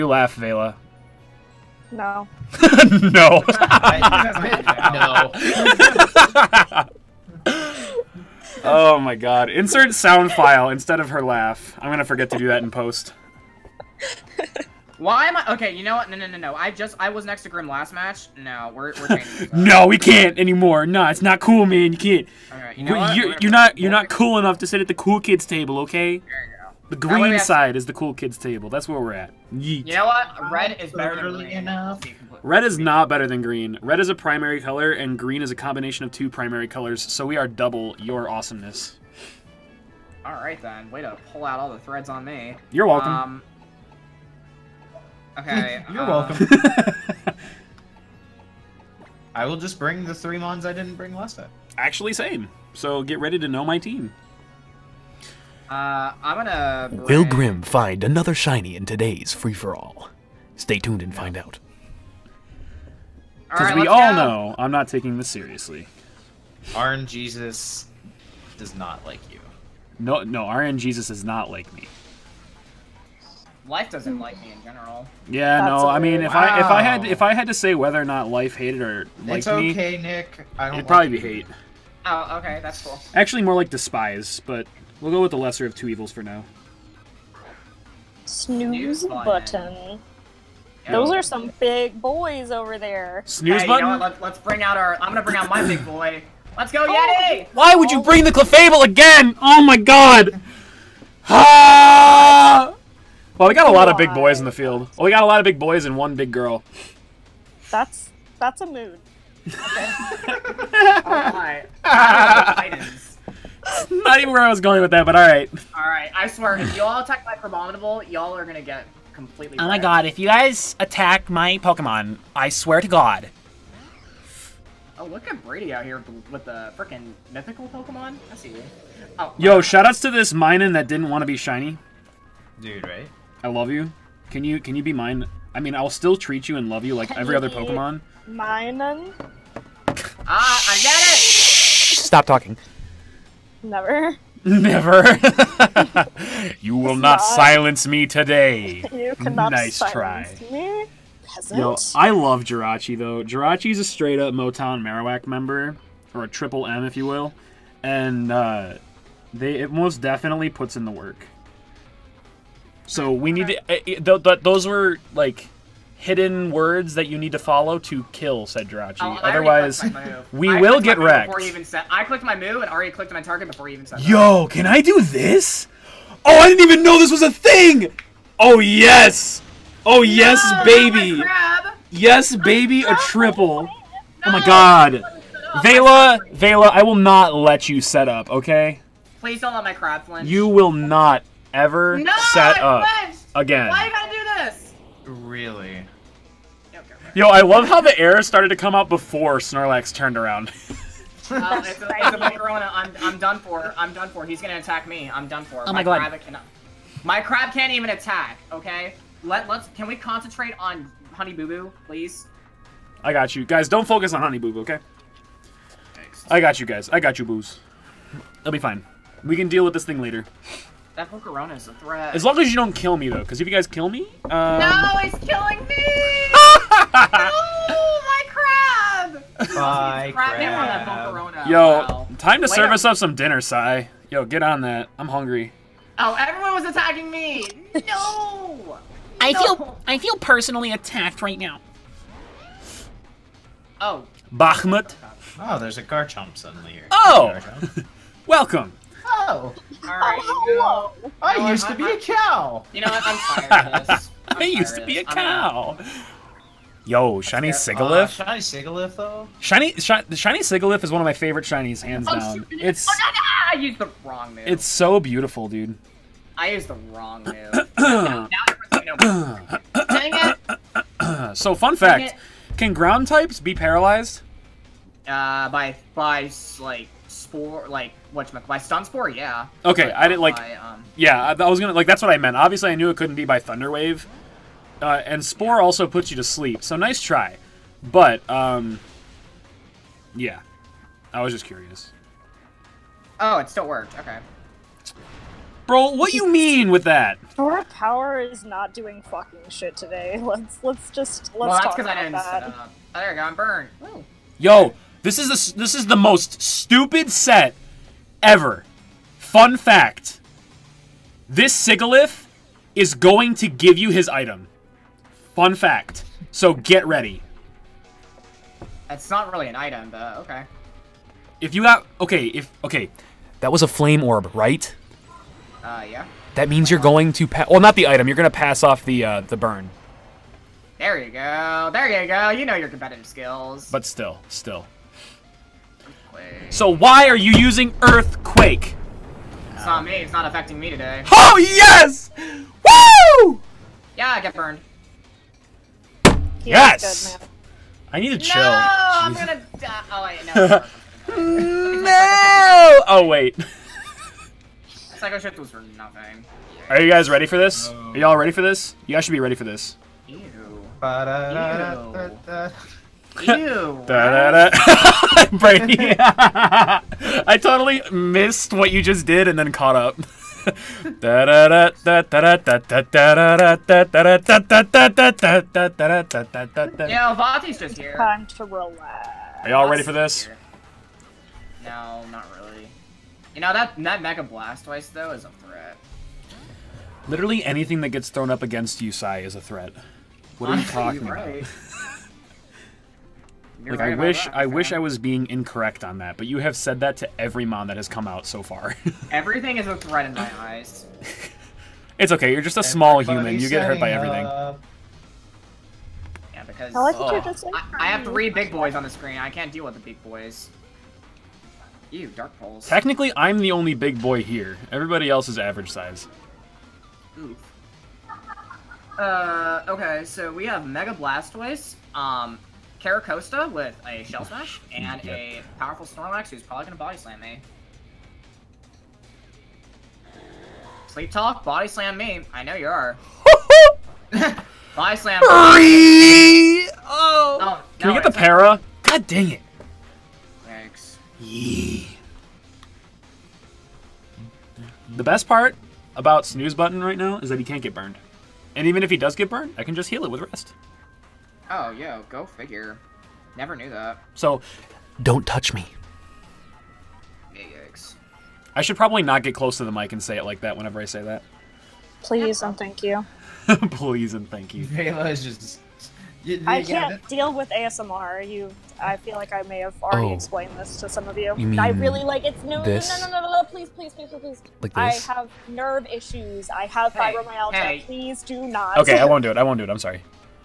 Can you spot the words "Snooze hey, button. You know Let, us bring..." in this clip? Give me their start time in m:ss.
1:33.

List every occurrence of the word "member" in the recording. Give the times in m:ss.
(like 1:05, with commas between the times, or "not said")
2:35.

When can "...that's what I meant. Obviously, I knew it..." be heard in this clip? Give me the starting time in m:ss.
4:41.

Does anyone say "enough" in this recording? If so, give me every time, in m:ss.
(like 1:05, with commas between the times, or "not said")
0:24, 0:31.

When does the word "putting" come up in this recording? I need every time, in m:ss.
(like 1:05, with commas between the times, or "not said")
not said.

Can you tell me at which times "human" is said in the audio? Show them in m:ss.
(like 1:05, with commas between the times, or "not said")
6:42.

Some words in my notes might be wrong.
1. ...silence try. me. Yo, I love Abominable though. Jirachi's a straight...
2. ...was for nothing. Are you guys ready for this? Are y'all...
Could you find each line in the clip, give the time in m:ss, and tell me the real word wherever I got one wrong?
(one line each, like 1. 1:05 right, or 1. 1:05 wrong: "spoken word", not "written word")
1. 2:29 wrong: "Jirachi", not "Abominable"
2. 5:55 right.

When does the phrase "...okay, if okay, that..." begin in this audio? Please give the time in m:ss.
5:22.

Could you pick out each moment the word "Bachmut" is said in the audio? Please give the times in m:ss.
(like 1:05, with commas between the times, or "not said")
4:04.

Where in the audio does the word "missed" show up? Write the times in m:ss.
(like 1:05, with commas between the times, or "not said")
6:07.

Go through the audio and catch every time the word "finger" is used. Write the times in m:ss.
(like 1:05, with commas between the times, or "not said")
not said.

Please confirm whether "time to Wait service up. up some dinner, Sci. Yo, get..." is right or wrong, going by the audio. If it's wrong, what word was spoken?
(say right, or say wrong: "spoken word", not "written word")
right.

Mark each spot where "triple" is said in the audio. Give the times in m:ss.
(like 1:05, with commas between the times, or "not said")
2:36, 3:02.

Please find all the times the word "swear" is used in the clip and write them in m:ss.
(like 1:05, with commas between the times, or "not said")
1:56, 2:02.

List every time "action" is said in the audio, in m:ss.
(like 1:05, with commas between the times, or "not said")
not said.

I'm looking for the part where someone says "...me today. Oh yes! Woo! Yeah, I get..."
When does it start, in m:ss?
5:40.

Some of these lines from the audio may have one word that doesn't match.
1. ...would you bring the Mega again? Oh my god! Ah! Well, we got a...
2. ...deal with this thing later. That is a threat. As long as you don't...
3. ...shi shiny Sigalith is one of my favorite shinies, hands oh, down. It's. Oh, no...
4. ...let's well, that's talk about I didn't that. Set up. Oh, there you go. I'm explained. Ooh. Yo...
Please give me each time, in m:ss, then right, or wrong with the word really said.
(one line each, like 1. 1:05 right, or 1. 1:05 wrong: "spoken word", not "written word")
1. 1:37 wrong: "Clefable", not "Mega"
2. 3:39 right
3. 4:19 right
4. 5:01 wrong: "burned", not "explained".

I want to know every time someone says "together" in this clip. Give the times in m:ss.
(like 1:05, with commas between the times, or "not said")
not said.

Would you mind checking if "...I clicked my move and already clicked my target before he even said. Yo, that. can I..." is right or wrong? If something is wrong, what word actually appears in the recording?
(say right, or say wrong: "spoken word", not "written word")
right.